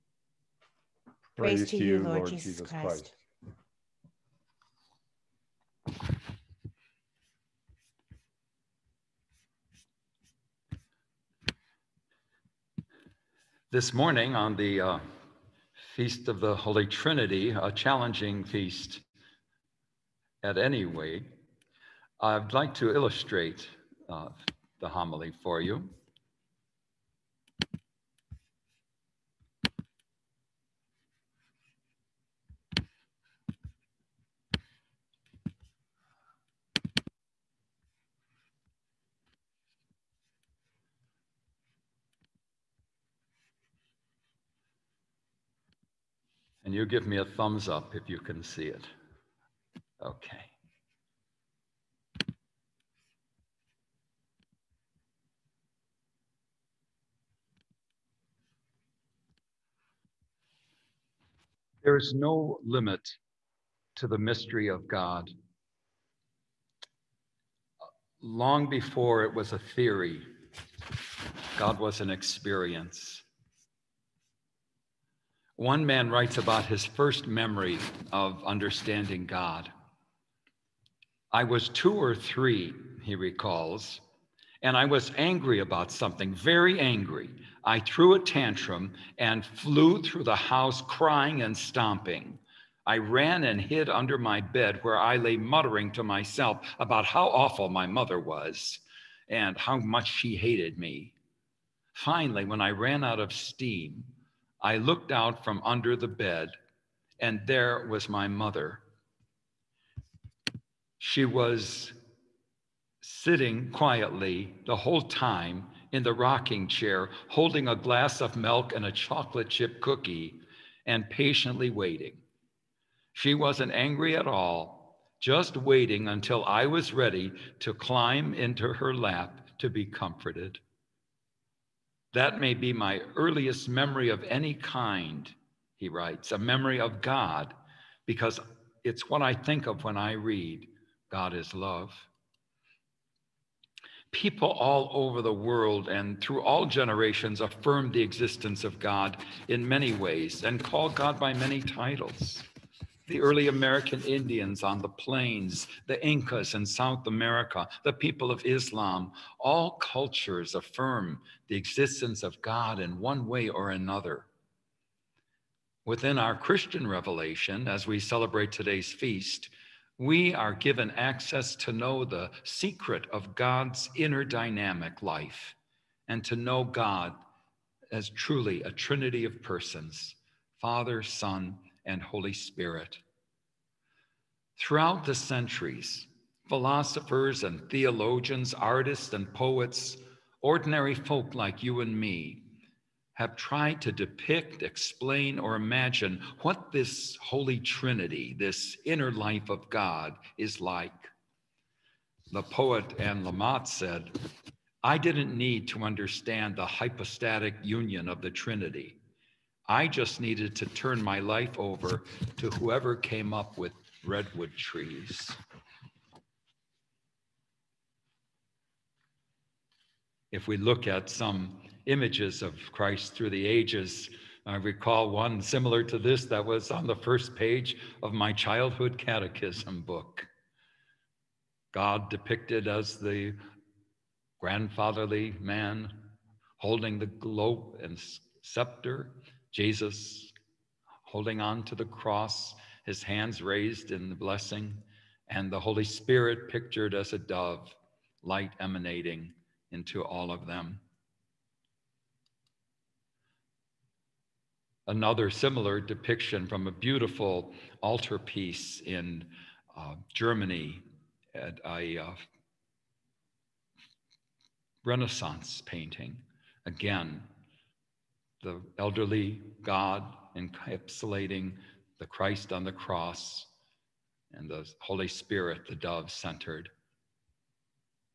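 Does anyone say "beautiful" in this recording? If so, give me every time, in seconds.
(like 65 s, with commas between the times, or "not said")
256 s.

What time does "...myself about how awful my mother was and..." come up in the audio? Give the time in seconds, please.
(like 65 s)
96 s.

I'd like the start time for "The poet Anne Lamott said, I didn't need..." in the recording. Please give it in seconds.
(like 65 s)
202 s.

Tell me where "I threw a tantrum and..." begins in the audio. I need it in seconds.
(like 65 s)
87 s.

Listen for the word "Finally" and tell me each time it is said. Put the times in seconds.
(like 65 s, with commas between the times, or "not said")
101 s.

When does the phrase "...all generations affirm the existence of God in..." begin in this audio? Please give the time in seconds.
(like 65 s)
146 s.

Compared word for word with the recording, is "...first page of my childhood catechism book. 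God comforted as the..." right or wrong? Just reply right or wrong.
wrong.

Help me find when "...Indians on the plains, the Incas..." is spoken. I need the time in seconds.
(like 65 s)
154 s.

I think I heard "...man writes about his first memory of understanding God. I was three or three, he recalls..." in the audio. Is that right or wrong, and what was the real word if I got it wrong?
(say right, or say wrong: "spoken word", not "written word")
wrong: "two", not "three".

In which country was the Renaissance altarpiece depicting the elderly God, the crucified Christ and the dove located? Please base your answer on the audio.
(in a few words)
Germany.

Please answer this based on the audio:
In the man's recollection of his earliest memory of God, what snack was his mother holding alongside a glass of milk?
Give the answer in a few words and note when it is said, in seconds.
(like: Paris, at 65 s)
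a chocolate chip cookie, at 118 s.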